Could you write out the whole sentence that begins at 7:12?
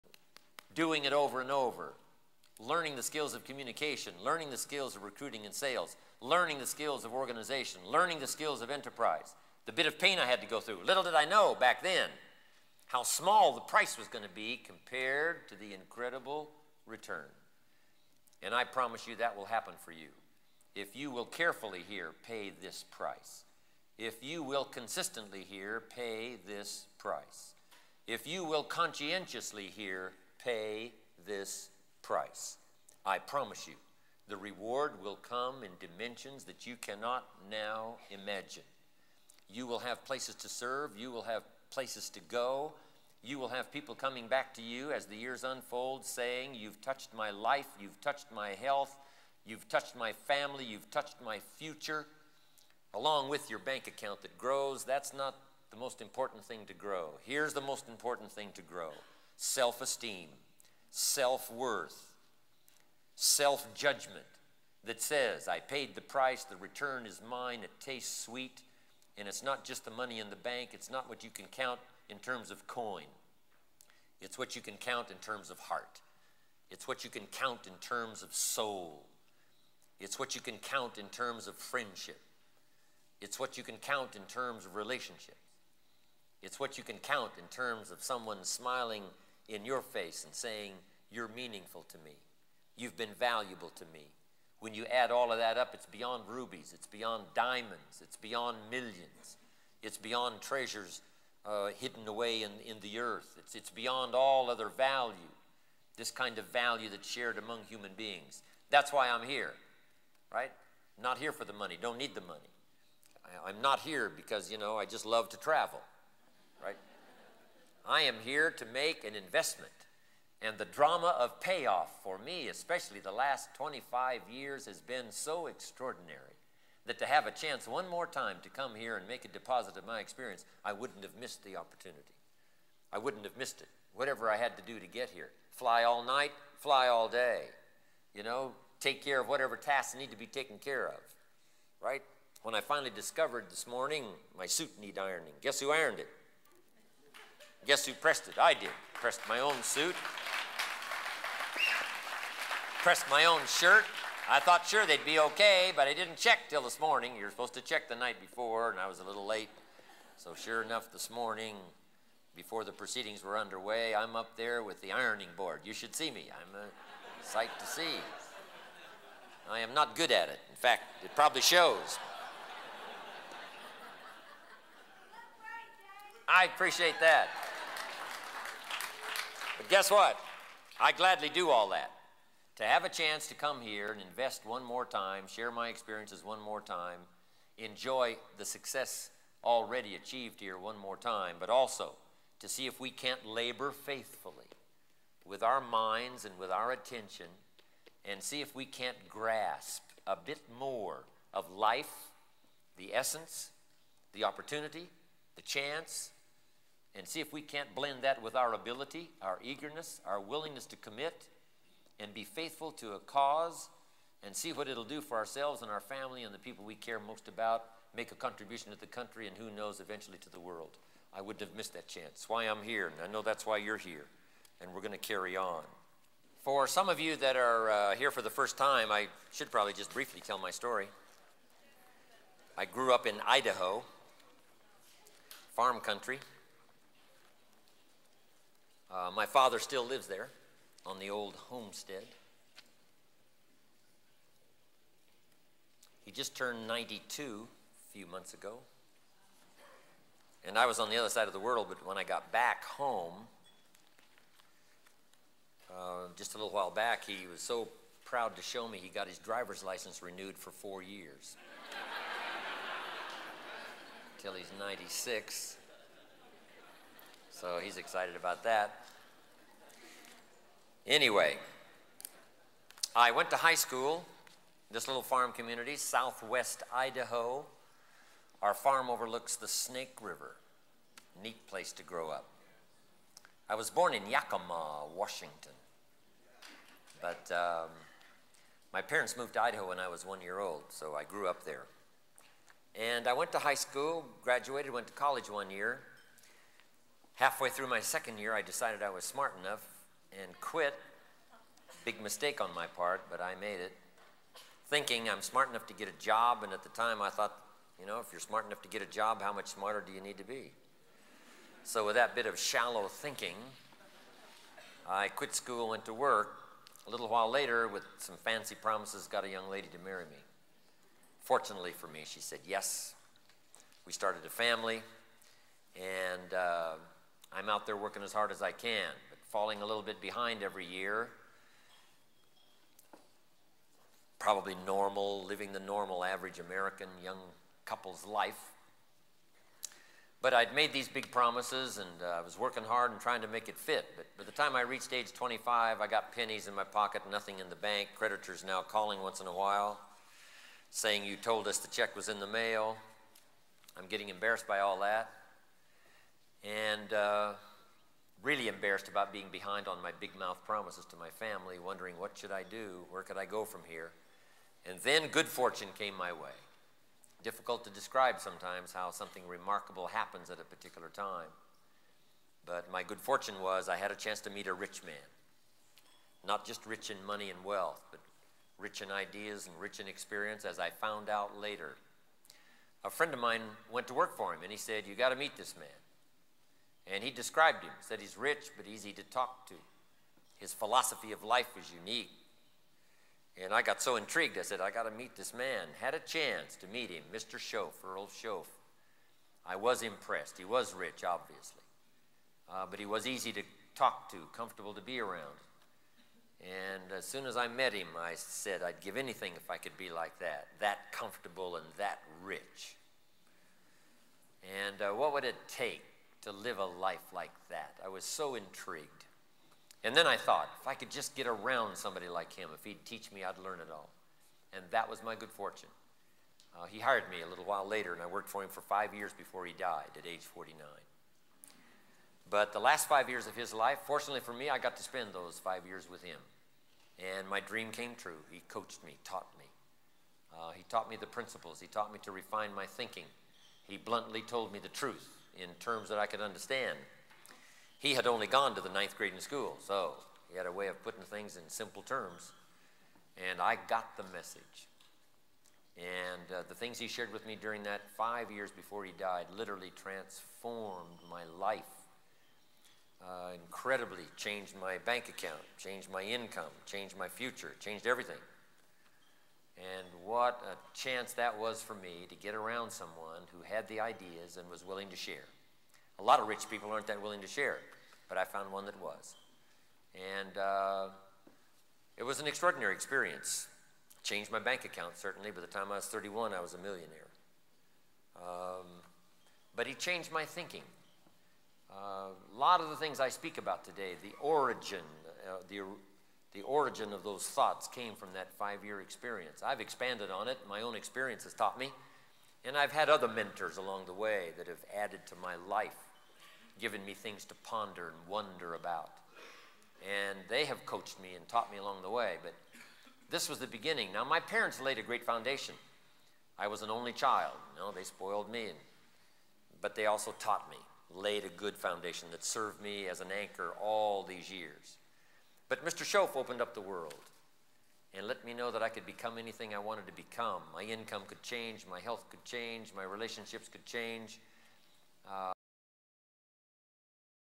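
But the last five years of his life, fortunately for me, I got to spend those five years with him.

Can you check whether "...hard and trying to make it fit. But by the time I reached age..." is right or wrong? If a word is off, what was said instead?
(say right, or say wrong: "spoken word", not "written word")
right.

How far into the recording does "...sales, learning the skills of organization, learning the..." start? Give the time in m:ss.
0:05.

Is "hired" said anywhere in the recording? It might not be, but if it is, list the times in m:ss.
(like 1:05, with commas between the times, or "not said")
7:06.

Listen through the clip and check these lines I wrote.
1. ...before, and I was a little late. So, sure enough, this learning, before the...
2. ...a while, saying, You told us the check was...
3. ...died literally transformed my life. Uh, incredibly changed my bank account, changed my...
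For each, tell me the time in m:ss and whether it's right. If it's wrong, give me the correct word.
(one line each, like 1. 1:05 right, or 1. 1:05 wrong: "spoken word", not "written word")
1. 2:38 wrong: "morning", not "learning"
2. 5:49 right
3. 7:38 right.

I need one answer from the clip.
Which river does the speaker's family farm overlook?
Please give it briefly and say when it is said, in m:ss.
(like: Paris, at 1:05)
Snake River, at 4:39.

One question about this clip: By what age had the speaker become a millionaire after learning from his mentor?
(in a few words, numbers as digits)
31.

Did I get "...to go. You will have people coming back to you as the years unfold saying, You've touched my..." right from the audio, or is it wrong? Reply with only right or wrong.
right.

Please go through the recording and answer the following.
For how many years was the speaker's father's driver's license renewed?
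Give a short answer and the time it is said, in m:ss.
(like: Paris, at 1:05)
4, at 4:20.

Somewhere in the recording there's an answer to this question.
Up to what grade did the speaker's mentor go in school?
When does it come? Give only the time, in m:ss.
7:28.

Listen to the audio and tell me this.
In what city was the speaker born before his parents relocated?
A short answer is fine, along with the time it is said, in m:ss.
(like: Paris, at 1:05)
Yakima, Washington, at 4:44.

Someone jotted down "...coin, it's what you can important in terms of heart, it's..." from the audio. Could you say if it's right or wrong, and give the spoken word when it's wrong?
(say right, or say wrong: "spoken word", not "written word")
wrong: "count", not "important".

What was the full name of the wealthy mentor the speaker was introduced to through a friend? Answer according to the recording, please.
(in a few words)
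Earl Shoaff.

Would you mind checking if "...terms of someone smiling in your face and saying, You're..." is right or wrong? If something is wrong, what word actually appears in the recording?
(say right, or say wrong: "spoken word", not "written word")
right.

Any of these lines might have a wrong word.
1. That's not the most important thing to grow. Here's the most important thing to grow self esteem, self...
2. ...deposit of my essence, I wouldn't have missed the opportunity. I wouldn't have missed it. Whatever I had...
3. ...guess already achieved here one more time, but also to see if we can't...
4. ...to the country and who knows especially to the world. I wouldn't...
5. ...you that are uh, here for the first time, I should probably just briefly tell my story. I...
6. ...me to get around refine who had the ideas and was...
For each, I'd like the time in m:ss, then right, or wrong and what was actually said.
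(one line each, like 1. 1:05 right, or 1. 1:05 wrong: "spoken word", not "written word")
1. 0:54 right
2. 2:09 wrong: "experience", not "essence"
3. 3:08 wrong: "success", not "guess"
4. 3:38 wrong: "eventually", not "especially"
5. 3:46 right
6. 7:51 wrong: "someone", not "refine".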